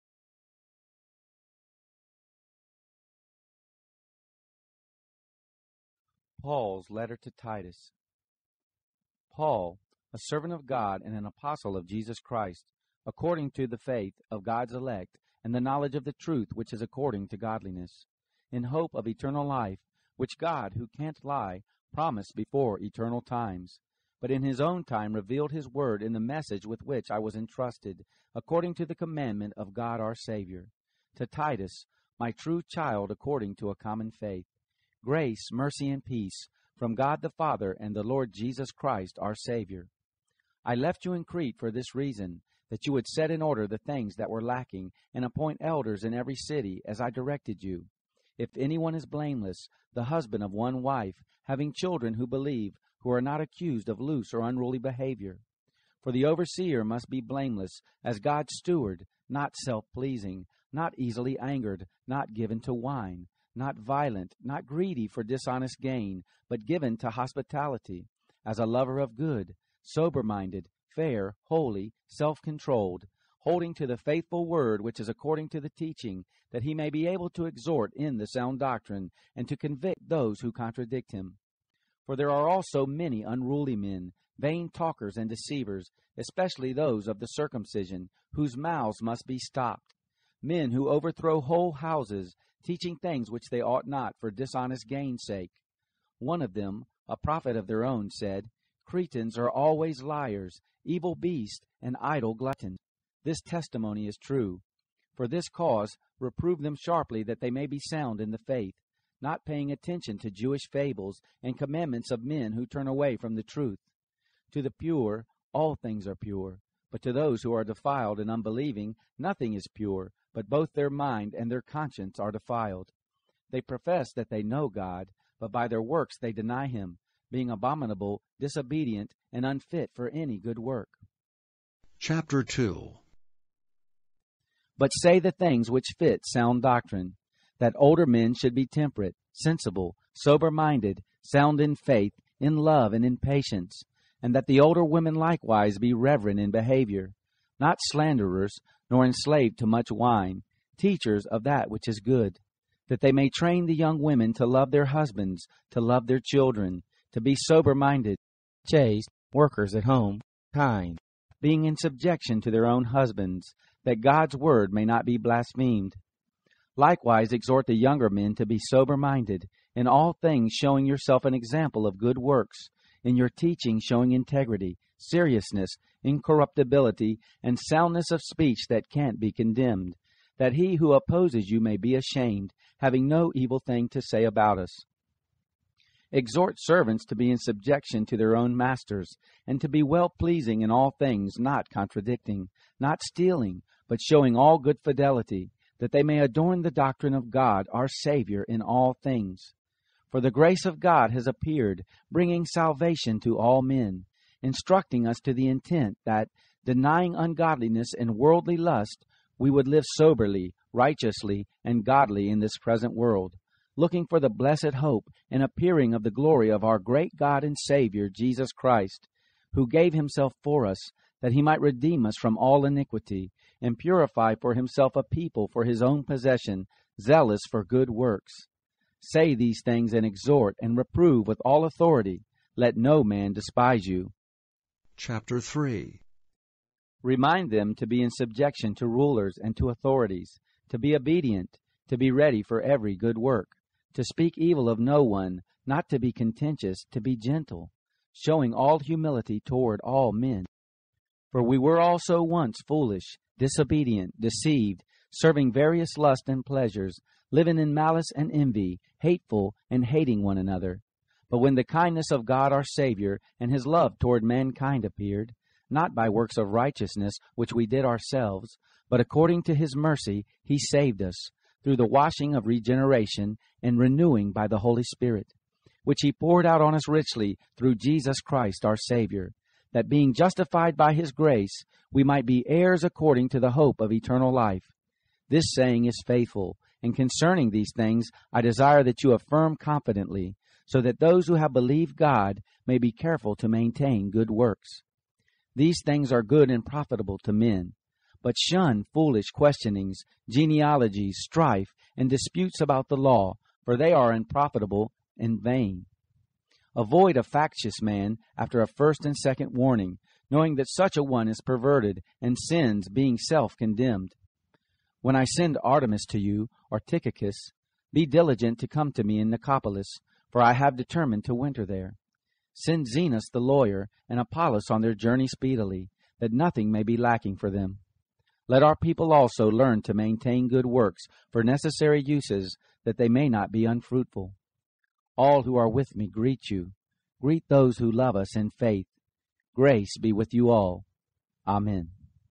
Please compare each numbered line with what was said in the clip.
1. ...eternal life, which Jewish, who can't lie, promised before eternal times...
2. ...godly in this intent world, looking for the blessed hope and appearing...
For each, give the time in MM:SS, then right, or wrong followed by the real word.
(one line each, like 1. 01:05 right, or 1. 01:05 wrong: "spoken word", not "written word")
1. 00:19 wrong: "God", not "Jewish"
2. 03:31 wrong: "present", not "intent".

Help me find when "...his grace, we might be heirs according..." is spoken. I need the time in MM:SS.
04:40.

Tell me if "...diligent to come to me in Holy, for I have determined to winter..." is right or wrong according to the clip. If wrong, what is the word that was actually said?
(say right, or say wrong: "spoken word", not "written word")
wrong: "Nicopolis", not "Holy".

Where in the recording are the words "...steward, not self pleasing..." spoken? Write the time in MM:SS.
00:58.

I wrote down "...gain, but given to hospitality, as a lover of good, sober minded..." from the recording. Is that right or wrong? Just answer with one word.
right.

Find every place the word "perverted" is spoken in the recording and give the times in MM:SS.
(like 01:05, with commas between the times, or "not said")
05:11.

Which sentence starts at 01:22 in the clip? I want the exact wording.
For there are also many unruly men, vain talkers and deceivers, especially those of the circumcision, whose mouths must be stopped.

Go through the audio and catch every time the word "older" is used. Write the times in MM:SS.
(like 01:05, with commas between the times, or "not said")
02:17, 02:24.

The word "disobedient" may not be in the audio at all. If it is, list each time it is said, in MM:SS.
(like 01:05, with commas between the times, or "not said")
02:08, 04:13.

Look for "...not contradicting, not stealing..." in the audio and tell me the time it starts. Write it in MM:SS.
03:11.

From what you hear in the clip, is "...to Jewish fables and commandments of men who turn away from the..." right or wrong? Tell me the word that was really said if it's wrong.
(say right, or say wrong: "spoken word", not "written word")
right.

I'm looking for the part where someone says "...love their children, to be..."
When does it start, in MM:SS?
02:35.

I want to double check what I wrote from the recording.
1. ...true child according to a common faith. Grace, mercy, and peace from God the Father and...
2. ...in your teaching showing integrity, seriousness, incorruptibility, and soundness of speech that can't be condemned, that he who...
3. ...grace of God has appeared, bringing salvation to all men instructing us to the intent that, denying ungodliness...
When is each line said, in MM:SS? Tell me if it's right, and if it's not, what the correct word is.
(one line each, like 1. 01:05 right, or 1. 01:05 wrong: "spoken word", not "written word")
1. 00:32 right
2. 02:53 right
3. 03:20 right.